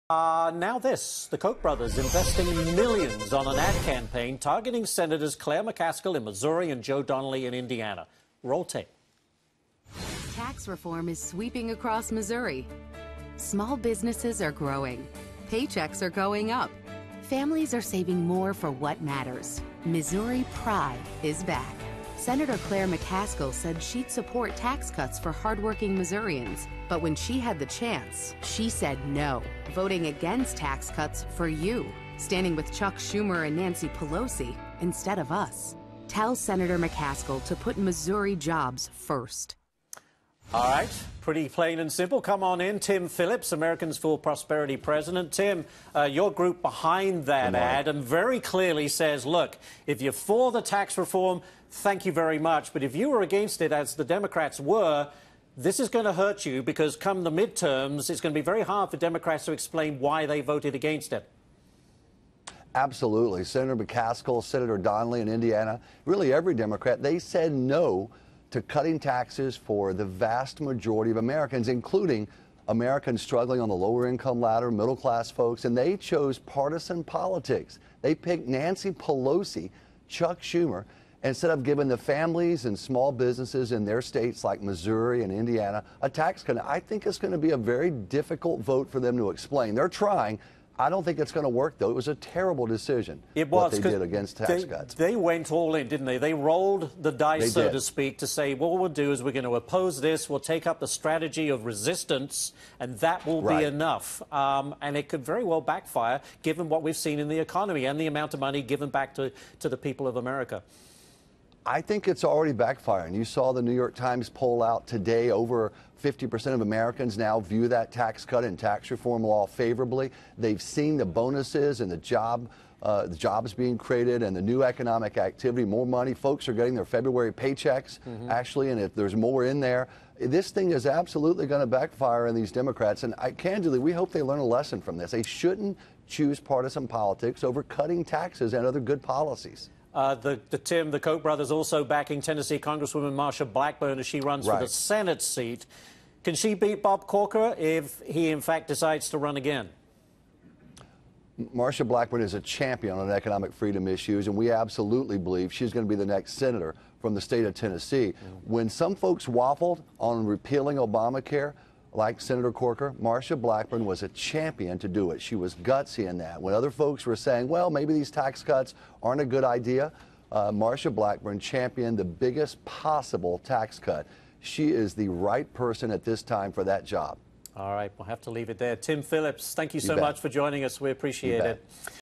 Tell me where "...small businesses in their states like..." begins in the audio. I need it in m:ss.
1:22.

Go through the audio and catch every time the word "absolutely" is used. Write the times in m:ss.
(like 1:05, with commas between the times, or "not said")
1:02, 2:10, 2:34.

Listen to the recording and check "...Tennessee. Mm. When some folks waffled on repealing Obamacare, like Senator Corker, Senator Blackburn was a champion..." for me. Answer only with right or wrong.
wrong.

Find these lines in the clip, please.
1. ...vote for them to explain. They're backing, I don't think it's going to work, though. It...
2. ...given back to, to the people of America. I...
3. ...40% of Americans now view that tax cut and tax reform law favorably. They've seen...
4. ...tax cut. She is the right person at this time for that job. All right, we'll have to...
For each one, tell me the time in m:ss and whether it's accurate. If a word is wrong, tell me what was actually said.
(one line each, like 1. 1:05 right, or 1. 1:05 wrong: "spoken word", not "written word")
1. 1:28 wrong: "trying", not "backing"
2. 1:48 right
3. 1:56 wrong: "50", not "40"
4. 2:53 right.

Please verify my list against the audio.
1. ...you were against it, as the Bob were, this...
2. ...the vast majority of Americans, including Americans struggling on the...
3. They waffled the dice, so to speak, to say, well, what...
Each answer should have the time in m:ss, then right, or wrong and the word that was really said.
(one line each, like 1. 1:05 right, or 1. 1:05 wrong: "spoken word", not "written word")
1. 0:52 wrong: "Democrats", not "Bob"
2. 1:09 right
3. 1:36 wrong: "rolled", not "waffled".